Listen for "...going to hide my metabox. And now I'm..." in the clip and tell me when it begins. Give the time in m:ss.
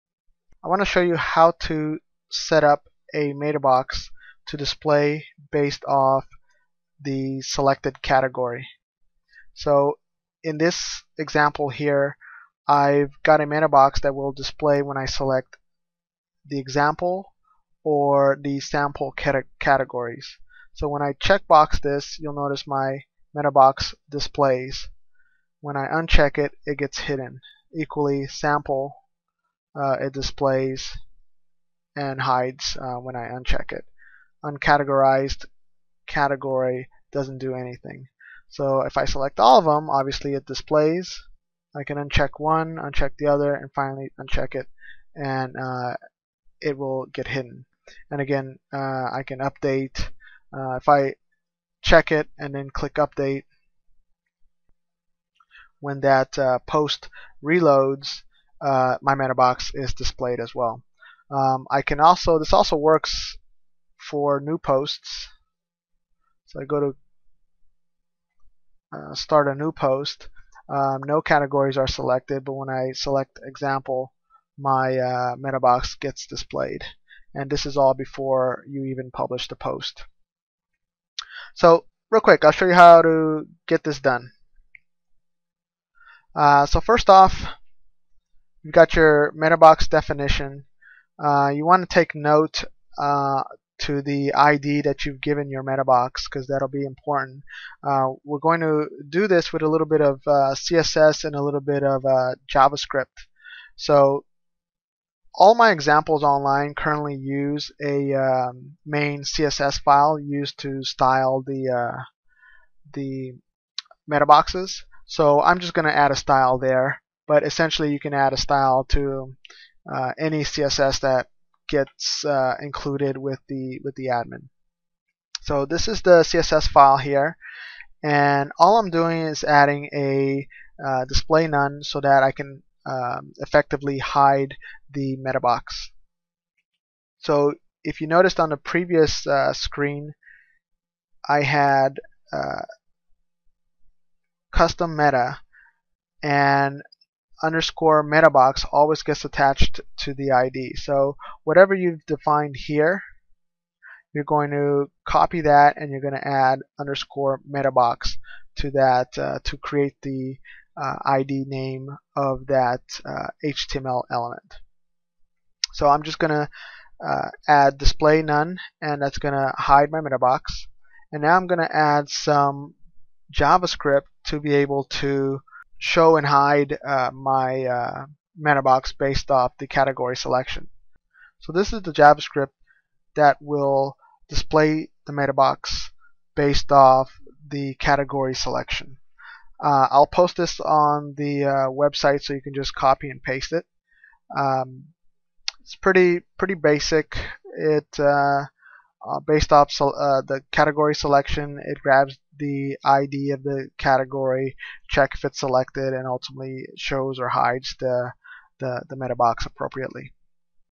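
2:49.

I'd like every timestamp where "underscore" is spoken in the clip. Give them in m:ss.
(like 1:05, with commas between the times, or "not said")
2:27, 2:36.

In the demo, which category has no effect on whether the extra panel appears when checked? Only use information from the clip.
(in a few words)
Uncategorized.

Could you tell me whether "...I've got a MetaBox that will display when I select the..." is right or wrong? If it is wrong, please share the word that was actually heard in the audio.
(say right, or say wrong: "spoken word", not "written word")
right.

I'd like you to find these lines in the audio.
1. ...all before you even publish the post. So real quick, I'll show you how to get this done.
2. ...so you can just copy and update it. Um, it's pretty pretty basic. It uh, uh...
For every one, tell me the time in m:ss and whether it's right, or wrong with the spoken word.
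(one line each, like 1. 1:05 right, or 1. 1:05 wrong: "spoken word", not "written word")
1. 1:17 right
2. 3:12 wrong: "paste", not "update".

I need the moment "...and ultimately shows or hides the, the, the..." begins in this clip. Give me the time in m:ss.
3:25.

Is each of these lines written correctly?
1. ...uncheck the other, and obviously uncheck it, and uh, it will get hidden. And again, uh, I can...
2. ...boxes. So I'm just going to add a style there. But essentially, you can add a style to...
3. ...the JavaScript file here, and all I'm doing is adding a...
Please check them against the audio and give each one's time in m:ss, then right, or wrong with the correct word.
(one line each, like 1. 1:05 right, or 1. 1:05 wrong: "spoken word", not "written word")
1. 0:42 wrong: "finally", not "obviously"
2. 1:54 right
3. 2:06 wrong: "CSS", not "JavaScript".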